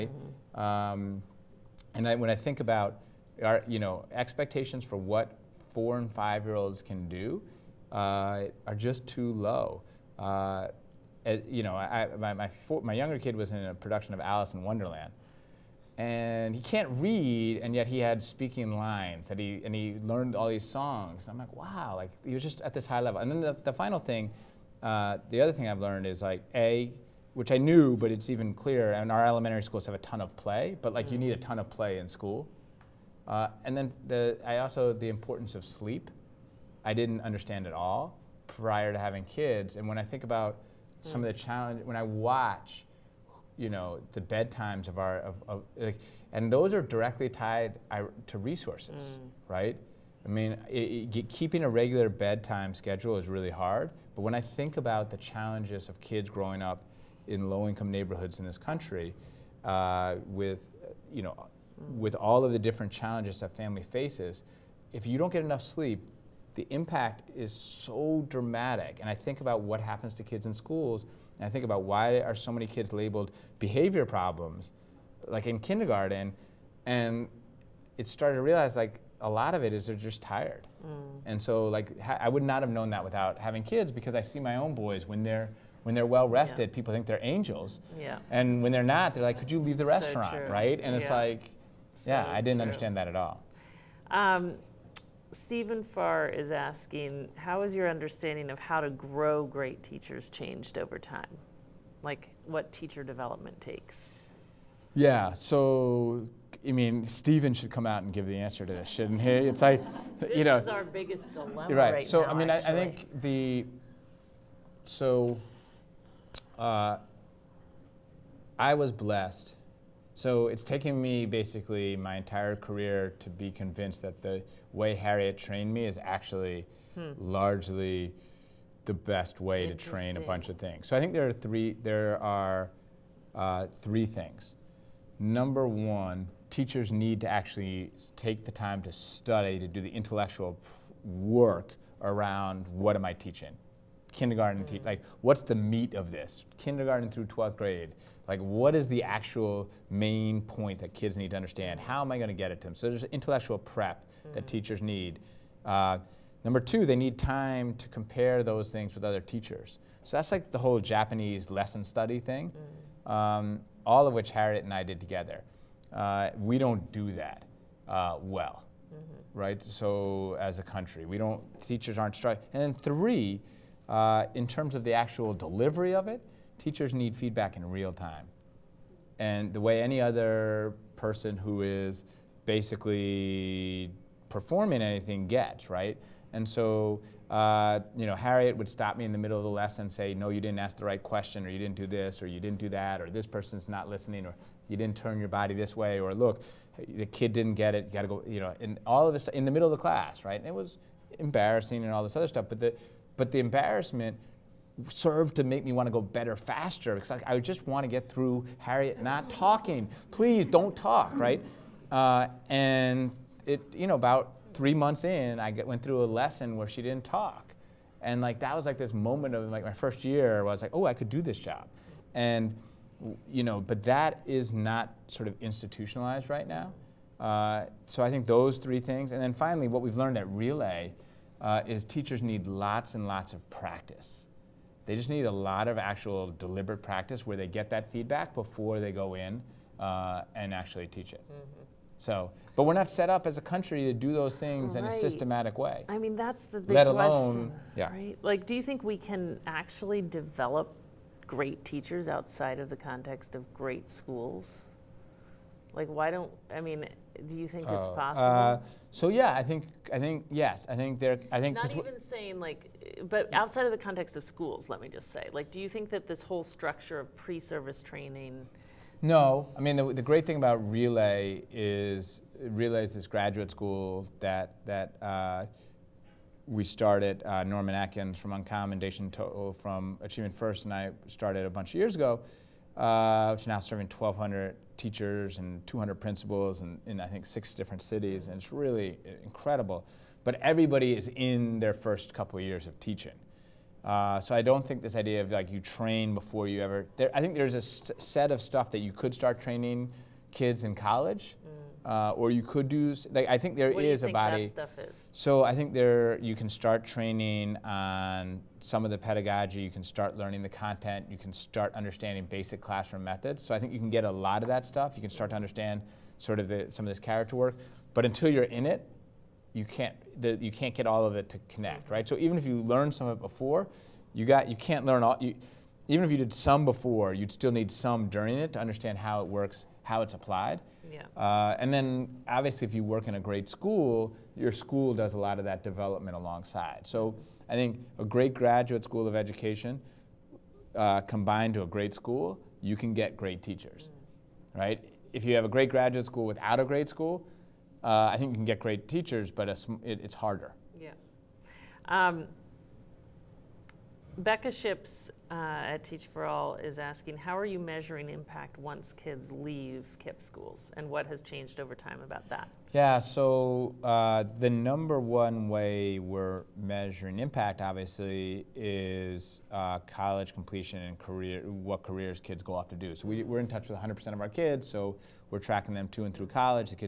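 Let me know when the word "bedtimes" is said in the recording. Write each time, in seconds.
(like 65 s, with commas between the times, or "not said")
44 s, 52 s.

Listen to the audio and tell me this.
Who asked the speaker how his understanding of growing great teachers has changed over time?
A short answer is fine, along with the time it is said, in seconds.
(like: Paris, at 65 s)
Steven Farr, at 95 s.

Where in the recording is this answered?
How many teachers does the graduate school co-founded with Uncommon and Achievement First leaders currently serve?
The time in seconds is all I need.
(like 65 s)
283 s.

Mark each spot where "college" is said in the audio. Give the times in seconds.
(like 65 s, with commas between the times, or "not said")
300 s, 369 s, 376 s.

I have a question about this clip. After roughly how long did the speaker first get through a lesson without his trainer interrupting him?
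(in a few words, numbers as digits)
3 months.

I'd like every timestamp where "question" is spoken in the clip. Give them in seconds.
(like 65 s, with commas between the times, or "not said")
191 s, 247 s.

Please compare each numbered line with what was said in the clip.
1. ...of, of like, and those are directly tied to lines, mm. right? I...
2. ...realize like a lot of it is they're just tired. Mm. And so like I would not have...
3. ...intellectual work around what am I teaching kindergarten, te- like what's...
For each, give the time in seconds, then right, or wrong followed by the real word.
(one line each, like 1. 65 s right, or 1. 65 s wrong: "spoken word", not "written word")
1. 45 s wrong: "resources", not "lines"
2. 78 s right
3. 139 s right.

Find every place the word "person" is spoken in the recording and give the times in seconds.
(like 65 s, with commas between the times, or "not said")
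180 s, 193 s.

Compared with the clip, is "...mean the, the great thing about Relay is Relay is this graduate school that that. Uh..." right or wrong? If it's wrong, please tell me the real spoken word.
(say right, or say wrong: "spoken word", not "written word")
right.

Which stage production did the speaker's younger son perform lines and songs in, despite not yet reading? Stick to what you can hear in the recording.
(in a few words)
Alice in Wonderland.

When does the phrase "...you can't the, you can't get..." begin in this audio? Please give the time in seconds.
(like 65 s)
319 s.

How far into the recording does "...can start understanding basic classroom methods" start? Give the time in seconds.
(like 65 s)
311 s.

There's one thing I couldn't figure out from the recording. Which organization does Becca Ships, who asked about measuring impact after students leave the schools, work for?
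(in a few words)
Teach for All.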